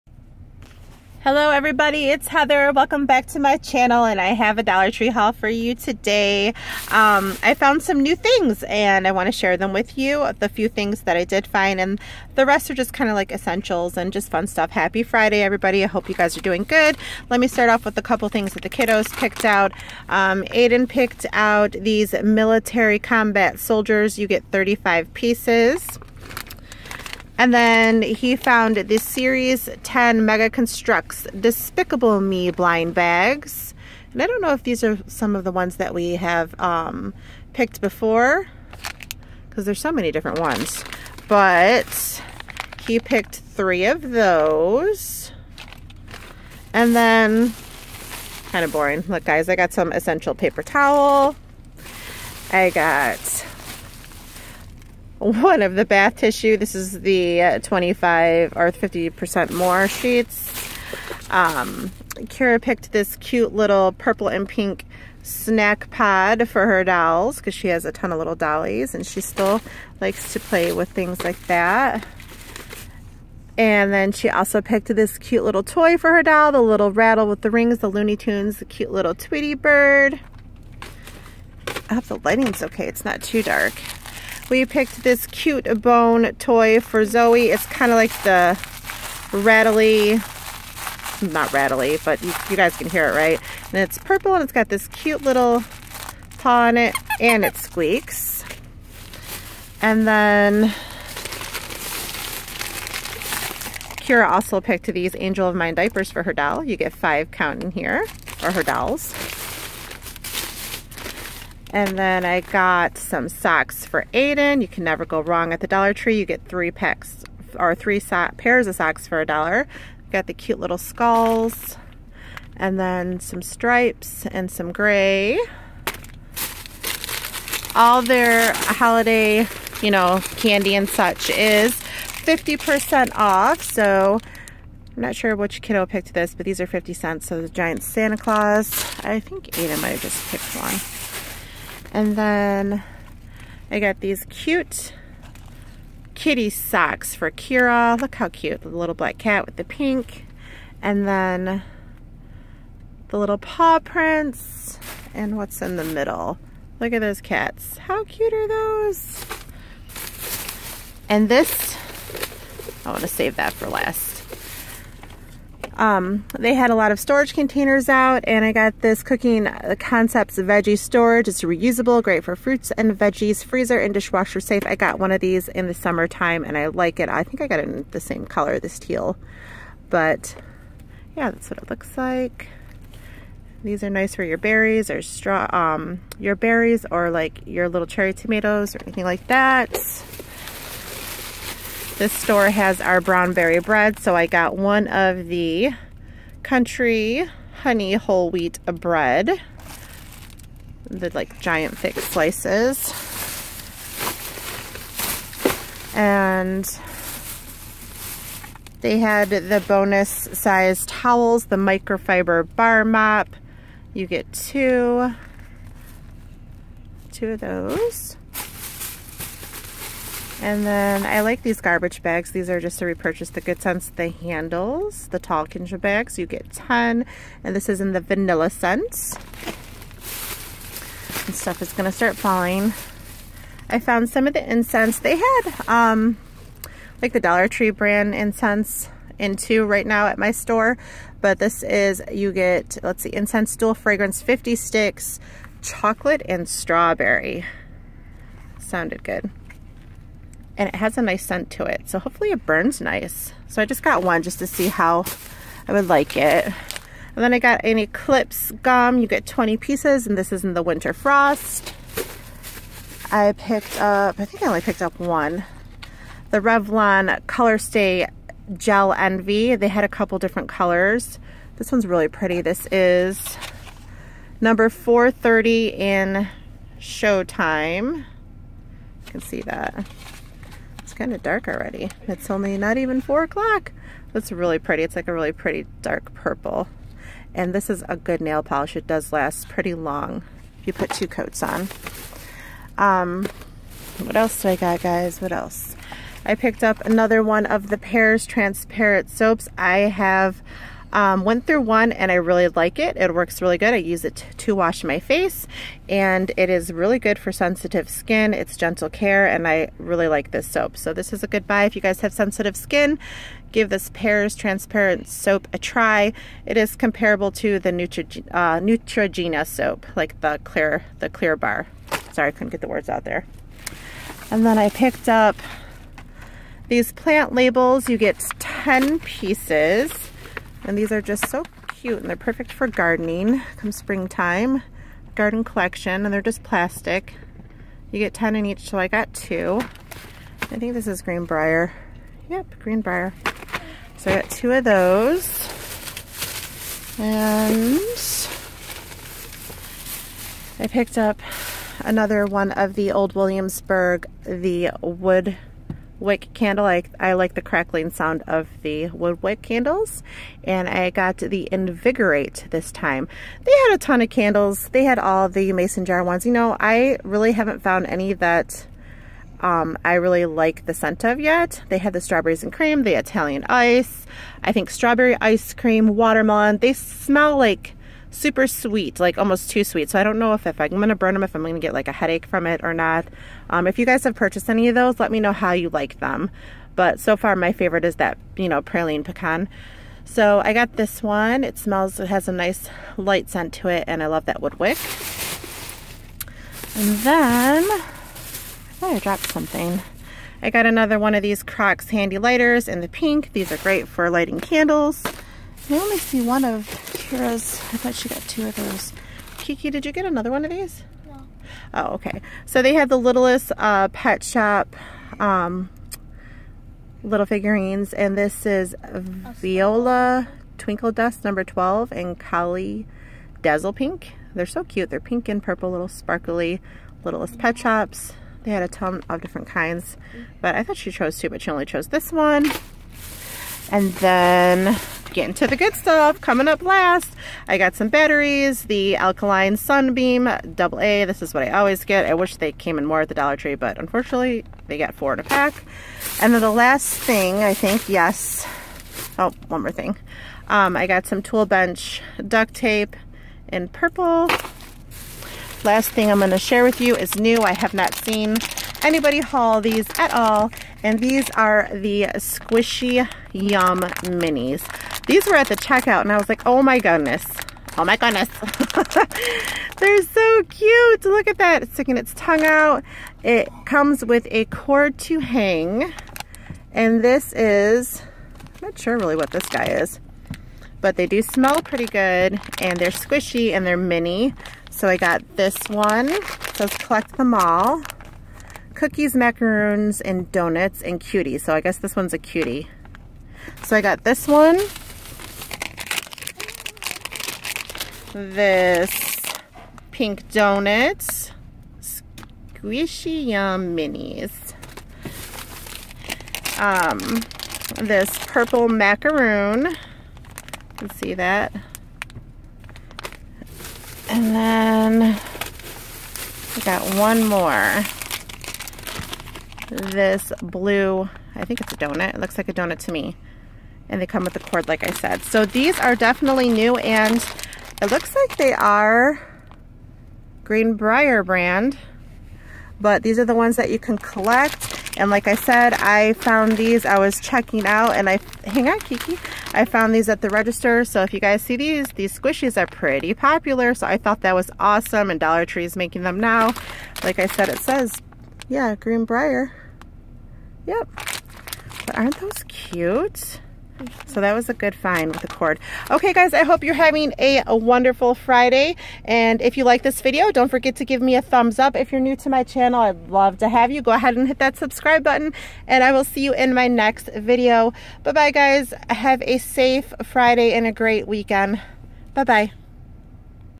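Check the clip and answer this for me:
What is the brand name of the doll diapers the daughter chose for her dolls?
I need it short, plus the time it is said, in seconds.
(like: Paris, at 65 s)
Angel of Mine, at 105 s.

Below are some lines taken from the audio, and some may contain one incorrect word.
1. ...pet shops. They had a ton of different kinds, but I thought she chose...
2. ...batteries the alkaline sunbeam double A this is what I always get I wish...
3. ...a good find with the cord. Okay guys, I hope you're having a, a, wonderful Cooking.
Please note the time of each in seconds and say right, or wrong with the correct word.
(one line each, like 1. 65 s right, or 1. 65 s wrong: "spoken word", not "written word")
1. 427 s right
2. 437 s right
3. 554 s wrong: "Friday", not "Cooking".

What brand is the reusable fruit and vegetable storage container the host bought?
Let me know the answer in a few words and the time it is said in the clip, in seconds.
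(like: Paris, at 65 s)
Cooking Concepts, at 169 s.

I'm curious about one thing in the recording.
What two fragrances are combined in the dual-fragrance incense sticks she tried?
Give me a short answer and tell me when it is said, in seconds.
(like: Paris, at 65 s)
chocolate and strawberry, at 245 s.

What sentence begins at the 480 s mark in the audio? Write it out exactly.
But they do smell pretty good.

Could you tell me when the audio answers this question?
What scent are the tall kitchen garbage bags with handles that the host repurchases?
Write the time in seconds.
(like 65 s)
228 s.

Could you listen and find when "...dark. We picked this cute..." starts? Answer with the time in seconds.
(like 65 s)
83 s.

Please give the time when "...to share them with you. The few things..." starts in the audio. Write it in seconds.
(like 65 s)
9 s.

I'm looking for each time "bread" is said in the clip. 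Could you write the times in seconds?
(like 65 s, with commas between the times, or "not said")
193 s, 198 s.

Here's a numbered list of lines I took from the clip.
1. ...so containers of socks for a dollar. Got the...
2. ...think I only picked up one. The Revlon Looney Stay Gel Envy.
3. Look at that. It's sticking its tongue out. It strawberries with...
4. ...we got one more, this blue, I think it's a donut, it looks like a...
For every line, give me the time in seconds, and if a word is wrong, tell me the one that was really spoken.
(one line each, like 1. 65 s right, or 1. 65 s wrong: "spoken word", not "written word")
1. 117 s wrong: "pairs", not "containers"
2. 264 s wrong: "Color", not "Looney"
3. 471 s wrong: "comes", not "strawberries"
4. 516 s right.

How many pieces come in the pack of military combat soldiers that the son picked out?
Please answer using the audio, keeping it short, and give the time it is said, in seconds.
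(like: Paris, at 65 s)
35, at 24 s.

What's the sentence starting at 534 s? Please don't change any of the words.
And like I said, I found these, I was checking out and I, hang on Kiki, I found these at the register.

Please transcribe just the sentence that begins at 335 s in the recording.
Garden collection and they're just plastic.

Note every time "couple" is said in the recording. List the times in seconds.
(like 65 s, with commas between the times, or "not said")
18 s, 269 s.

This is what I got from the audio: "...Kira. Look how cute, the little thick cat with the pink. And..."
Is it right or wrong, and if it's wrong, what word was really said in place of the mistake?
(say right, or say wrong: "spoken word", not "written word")
wrong: "black", not "thick".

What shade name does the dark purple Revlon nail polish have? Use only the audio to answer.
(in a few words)
Showtime.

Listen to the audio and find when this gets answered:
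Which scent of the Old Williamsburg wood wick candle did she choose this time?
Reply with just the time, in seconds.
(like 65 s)
361 s.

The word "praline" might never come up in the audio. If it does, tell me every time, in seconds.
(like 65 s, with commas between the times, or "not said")
388 s.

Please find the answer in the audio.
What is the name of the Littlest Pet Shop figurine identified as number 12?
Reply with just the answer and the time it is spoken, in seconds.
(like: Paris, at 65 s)
Viola Twinkle Dust, at 418 s.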